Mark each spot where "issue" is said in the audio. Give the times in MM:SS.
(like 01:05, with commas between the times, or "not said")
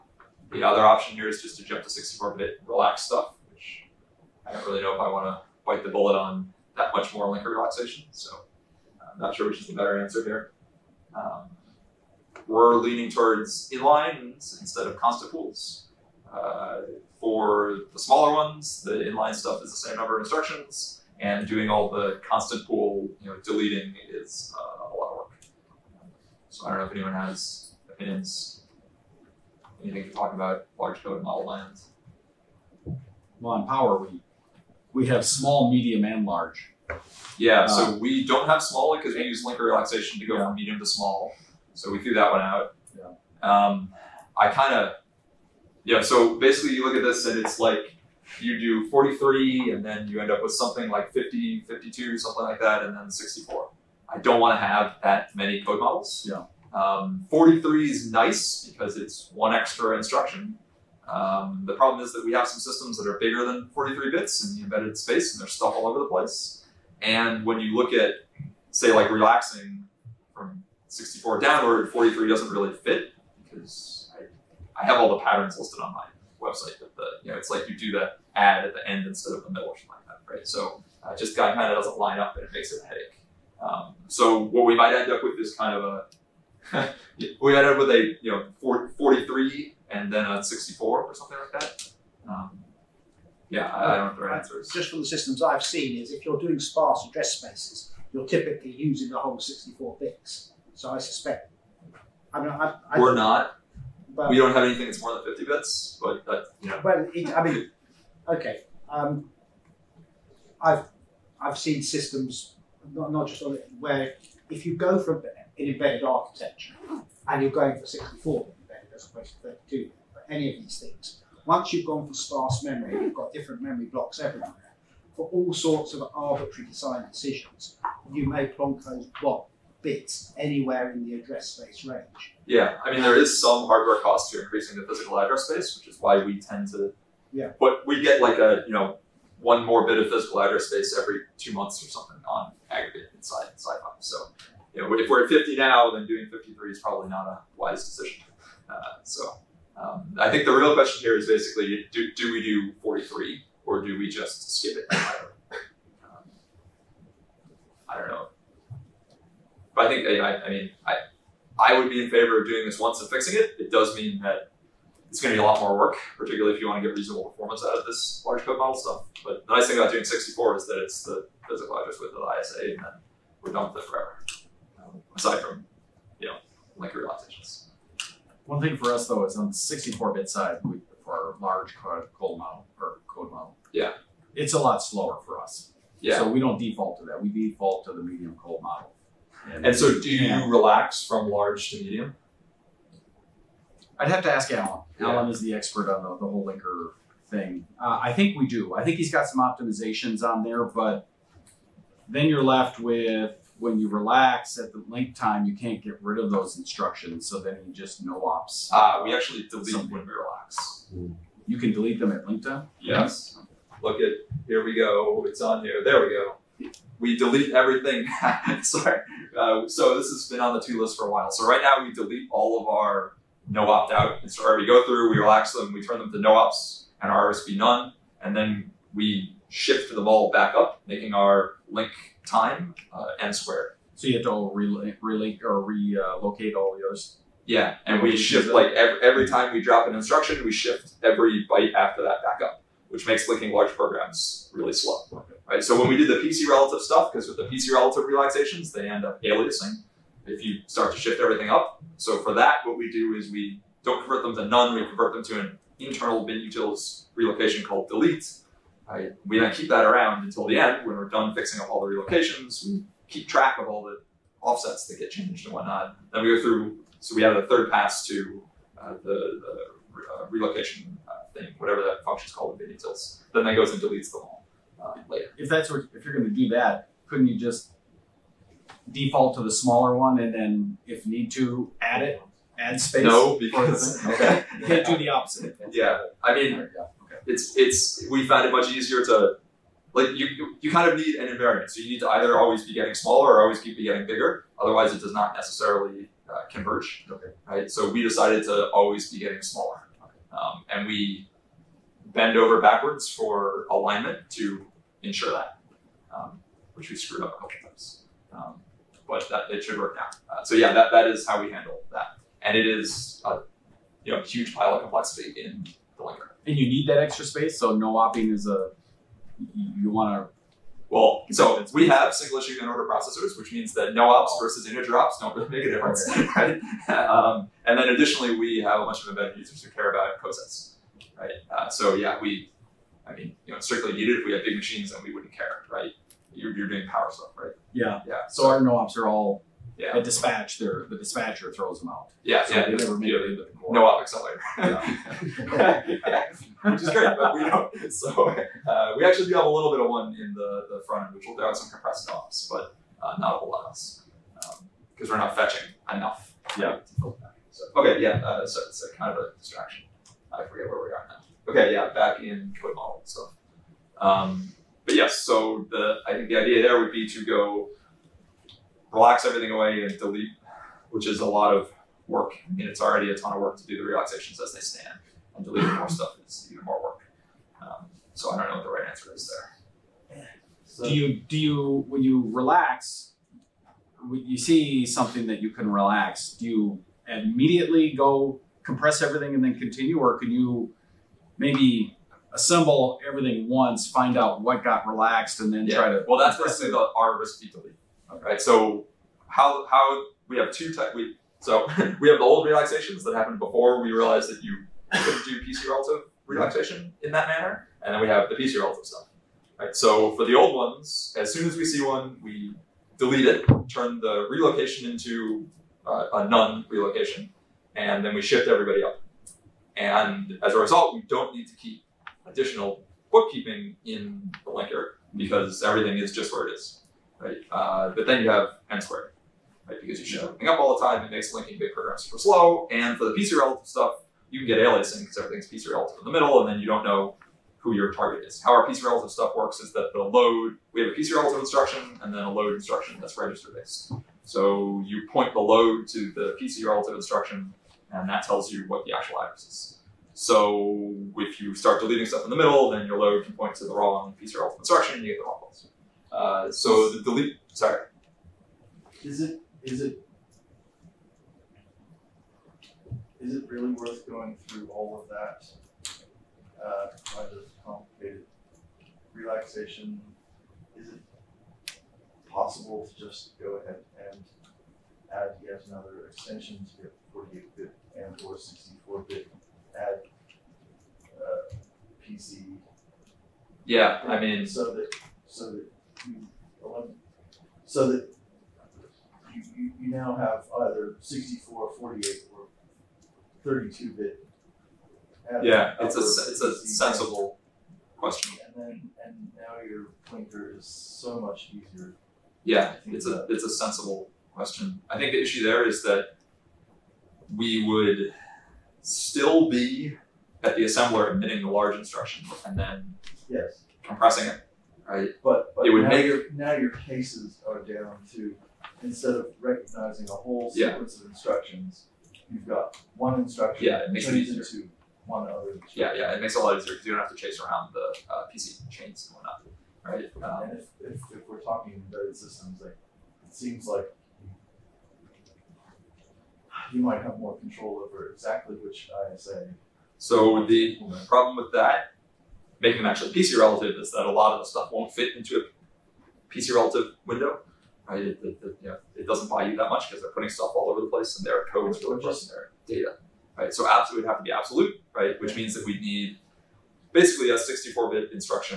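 05:22, 08:25.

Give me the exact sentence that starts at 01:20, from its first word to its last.
So uh, just guy kind of doesn't line up, and it makes it a headache.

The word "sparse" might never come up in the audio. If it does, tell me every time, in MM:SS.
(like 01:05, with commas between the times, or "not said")
01:36, 02:02.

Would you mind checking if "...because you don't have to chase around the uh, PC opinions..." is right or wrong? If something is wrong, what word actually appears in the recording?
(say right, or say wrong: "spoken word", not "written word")
wrong: "chains", not "opinions".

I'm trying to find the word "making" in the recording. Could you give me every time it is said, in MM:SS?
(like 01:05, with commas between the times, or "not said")
03:50, 09:02.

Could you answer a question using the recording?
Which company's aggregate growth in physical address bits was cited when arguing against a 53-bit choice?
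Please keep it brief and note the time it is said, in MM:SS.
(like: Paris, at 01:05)
SiFive, at 02:23.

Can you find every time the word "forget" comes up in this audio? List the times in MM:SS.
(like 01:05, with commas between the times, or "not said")
06:00.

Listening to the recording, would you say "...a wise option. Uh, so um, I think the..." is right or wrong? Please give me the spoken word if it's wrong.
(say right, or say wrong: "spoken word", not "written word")
wrong: "decision", not "option".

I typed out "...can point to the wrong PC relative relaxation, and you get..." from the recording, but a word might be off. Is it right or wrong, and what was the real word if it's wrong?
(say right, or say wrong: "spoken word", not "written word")
wrong: "instruction", not "relaxation".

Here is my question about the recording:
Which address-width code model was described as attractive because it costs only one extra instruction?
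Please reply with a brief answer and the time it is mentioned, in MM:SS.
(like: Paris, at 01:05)
43, at 00:57.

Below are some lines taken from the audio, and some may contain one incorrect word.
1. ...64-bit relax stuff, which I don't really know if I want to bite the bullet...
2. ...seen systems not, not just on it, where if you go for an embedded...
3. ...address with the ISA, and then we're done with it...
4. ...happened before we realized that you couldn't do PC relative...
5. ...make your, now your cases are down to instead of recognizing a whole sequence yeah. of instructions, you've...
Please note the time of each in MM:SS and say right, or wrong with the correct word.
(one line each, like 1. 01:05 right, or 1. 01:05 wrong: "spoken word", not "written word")
1. 00:01 right
2. 01:51 right
3. 02:51 right
4. 06:43 right
5. 08:35 right.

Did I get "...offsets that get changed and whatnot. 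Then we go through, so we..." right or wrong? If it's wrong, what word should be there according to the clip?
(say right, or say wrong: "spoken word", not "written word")
right.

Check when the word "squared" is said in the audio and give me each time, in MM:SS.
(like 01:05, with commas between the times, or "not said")
03:53, 07:08.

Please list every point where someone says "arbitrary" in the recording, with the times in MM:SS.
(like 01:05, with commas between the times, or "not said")
02:06.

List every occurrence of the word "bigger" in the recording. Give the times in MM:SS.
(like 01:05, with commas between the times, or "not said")
01:03, 04:54.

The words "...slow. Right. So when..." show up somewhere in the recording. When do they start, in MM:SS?
04:04.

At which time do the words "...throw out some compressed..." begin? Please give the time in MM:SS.
05:51.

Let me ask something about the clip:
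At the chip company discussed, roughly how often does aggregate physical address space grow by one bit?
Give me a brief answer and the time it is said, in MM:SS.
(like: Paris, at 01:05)
Every two months, at 02:20.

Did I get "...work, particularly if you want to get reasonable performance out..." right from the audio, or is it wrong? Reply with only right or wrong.
right.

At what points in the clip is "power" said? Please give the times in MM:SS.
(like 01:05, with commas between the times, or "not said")
00:33, 05:36.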